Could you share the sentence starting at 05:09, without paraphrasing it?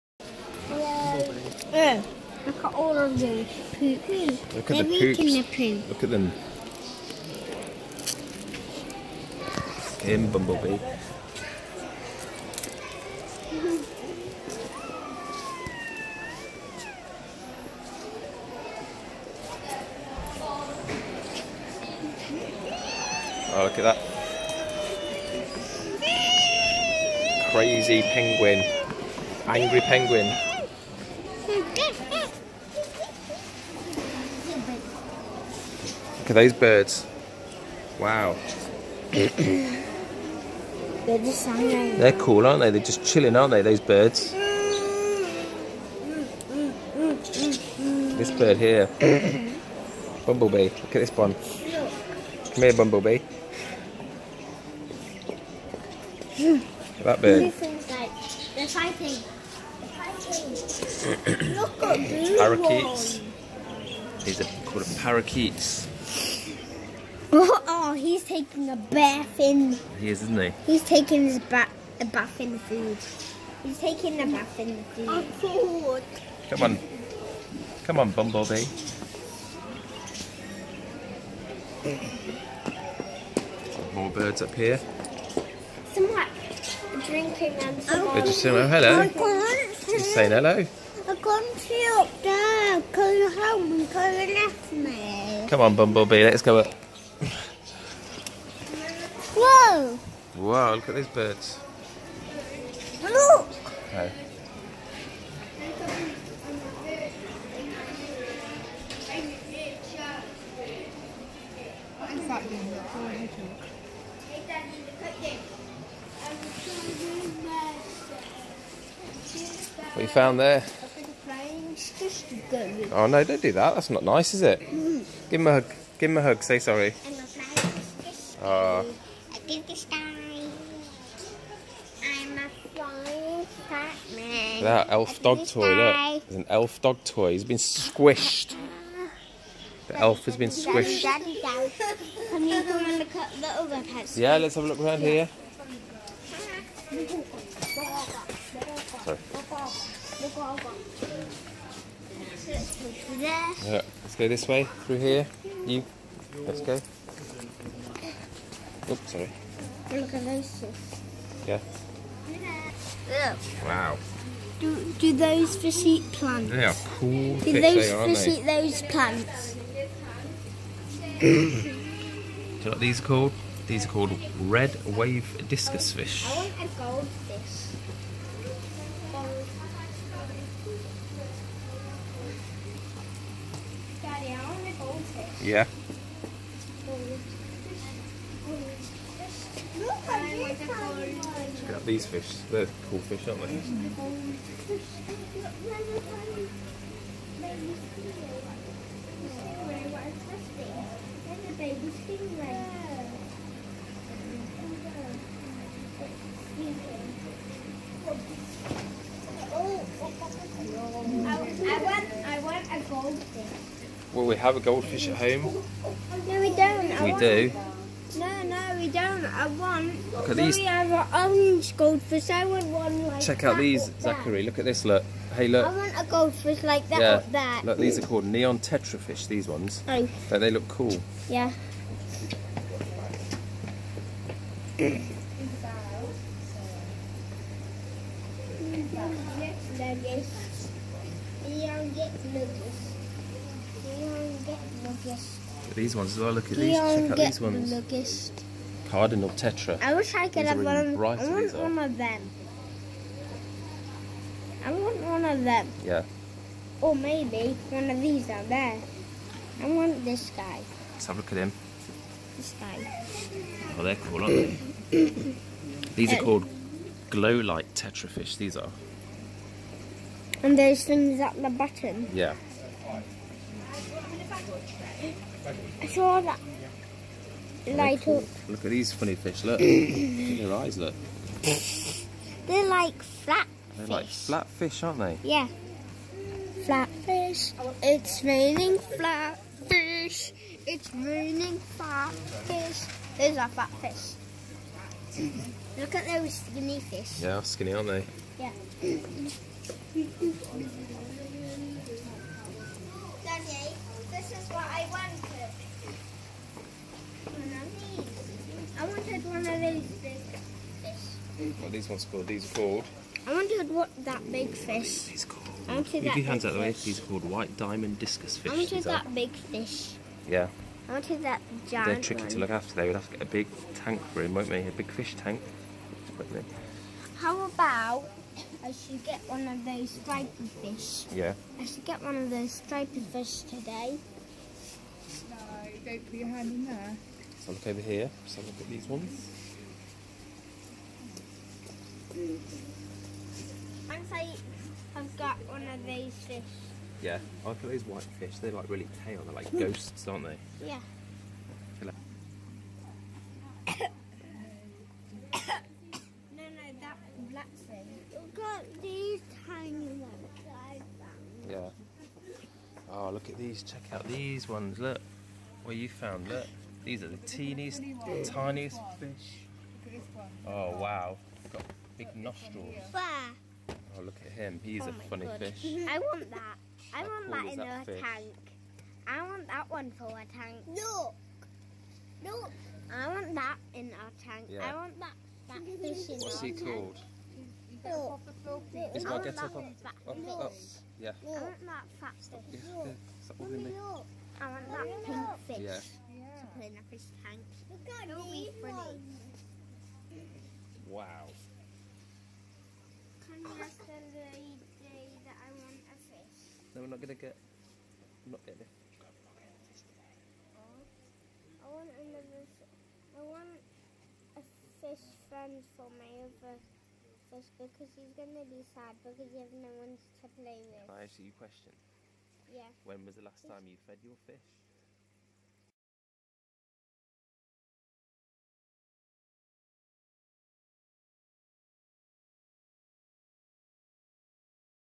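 wanted one of these big fish.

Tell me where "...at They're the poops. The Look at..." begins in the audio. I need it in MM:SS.
00:04.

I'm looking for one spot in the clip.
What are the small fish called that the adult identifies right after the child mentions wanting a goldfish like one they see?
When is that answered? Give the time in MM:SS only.
03:48.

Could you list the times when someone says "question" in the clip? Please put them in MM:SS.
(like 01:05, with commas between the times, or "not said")
07:01.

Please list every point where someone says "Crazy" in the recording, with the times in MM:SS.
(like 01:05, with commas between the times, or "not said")
00:27.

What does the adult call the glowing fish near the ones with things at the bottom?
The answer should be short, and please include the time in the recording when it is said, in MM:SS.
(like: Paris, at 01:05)
Glow light fish, at 04:27.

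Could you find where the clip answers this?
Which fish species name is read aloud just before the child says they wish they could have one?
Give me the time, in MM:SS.
04:08.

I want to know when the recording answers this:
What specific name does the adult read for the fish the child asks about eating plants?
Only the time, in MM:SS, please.
02:54.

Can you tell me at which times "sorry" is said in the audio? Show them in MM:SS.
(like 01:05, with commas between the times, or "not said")
02:06, 02:29, 02:39.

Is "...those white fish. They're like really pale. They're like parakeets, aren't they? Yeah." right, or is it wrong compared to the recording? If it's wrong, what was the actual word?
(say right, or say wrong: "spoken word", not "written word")
wrong: "ghosts", not "parakeets".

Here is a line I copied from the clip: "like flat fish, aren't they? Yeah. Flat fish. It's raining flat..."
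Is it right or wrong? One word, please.
right.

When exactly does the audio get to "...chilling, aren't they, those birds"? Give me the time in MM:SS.
00:43.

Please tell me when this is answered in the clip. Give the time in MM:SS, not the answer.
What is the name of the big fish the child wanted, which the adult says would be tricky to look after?
05:17.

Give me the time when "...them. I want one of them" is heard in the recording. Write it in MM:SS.
04:11.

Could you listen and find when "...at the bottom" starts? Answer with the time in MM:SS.
04:31.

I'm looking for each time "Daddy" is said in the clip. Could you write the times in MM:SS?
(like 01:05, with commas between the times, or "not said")
03:04, 04:58.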